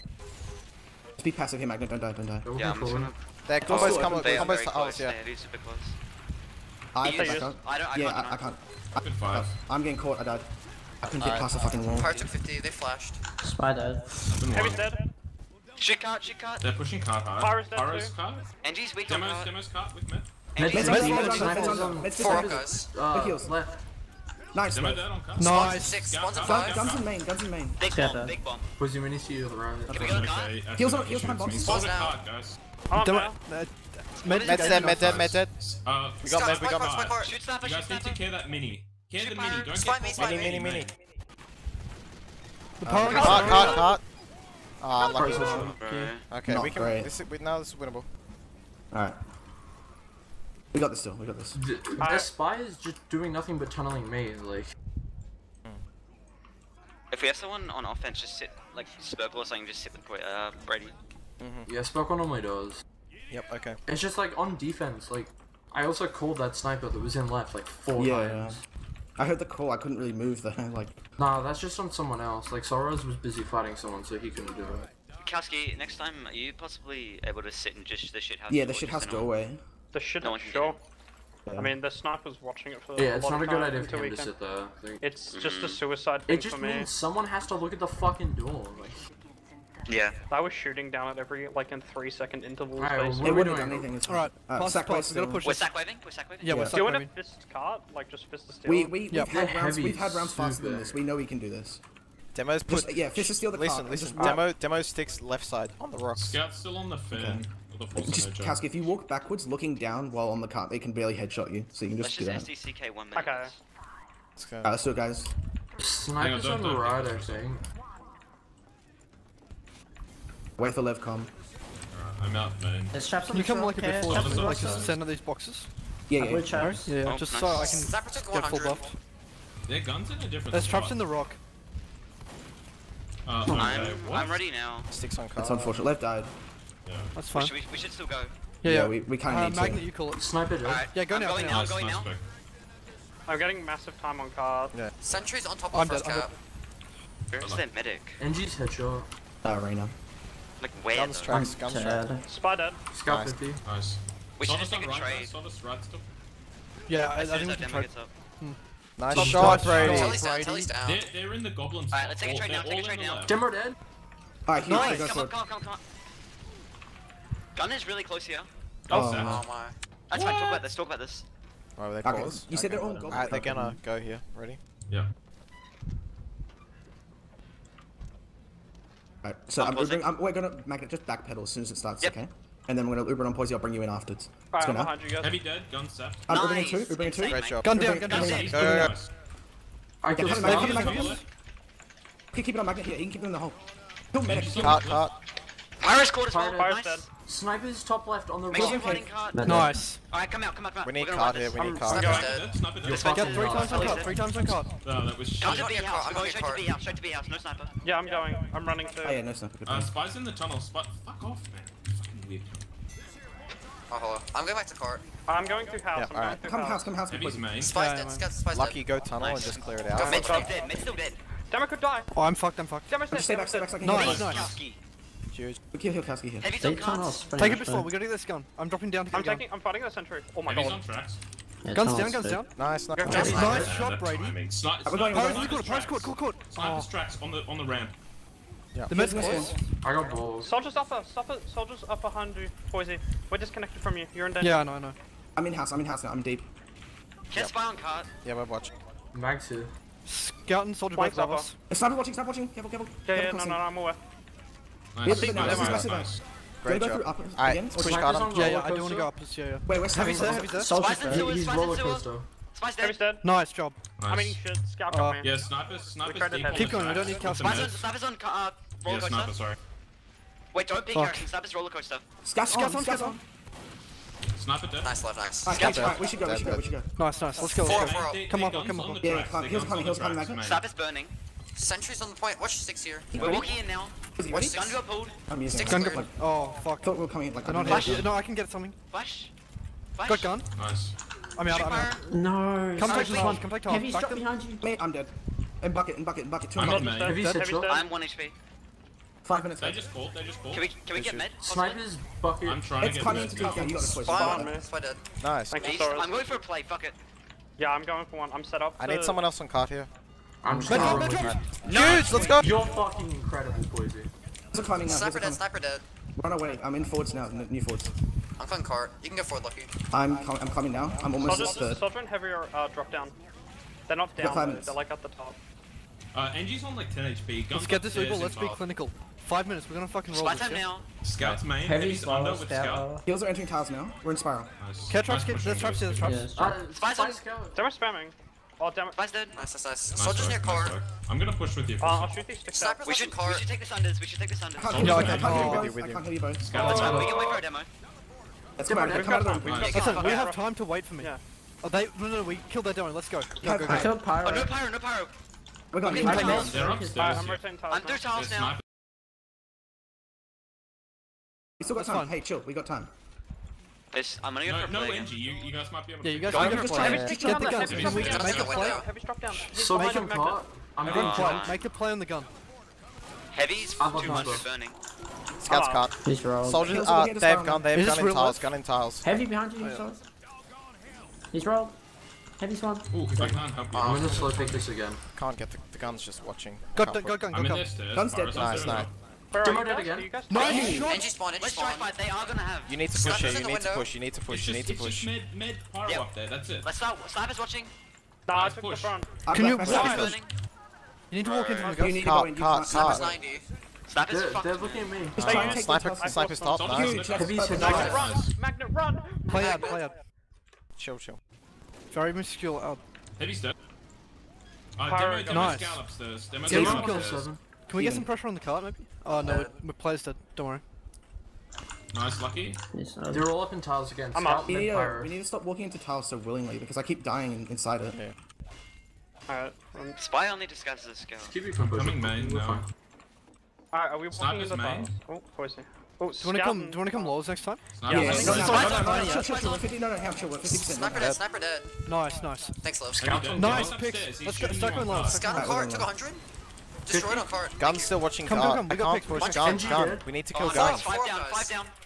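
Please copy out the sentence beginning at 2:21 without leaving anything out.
Going now, nice, going nice now.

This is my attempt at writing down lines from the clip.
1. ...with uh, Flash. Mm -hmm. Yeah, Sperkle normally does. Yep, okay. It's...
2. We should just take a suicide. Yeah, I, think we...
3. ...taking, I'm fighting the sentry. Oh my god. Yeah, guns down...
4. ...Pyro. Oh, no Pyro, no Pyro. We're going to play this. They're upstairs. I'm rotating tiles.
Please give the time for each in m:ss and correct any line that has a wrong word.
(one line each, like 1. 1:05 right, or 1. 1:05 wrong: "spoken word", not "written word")
1. 0:59 wrong: "Brady", not "Flash"
2. 2:34 wrong: "trade", not "suicide"
3. 3:49 right
4. 5:54 right.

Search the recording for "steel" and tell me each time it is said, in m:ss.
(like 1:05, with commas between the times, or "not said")
1:38, 1:43.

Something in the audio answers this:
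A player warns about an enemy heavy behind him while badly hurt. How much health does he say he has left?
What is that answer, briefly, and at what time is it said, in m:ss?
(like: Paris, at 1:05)
1 HP, at 4:57.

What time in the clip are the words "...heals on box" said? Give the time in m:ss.
0:31.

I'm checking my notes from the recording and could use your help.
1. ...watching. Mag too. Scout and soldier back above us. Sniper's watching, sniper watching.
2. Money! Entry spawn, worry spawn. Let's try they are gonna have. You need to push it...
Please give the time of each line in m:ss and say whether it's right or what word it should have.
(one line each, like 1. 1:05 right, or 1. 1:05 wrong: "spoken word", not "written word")
1. 4:08 right
2. 6:30 wrong: "entry", not "worry".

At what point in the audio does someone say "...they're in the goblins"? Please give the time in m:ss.
2:41.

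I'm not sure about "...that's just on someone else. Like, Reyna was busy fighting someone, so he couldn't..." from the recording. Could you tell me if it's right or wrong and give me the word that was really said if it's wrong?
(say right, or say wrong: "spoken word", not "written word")
wrong: "Soros", not "Reyna".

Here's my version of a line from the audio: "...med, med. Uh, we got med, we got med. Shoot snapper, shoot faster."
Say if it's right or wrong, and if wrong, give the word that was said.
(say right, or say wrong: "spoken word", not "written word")
wrong: "snapper", not "faster".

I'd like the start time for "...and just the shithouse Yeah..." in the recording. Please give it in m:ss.
1:17.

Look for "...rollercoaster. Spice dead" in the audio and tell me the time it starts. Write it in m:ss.
4:21.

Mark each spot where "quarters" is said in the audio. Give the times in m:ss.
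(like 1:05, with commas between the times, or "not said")
3:16.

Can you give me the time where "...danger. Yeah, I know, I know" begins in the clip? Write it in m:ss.
4:04.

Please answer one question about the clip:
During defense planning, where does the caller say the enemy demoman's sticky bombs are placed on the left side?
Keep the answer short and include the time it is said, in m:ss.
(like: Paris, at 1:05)
On the rocks, at 1:45.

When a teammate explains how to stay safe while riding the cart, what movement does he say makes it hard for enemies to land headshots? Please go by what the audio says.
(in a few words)
Walk backwards.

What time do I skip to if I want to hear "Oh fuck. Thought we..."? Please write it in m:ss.
4:46.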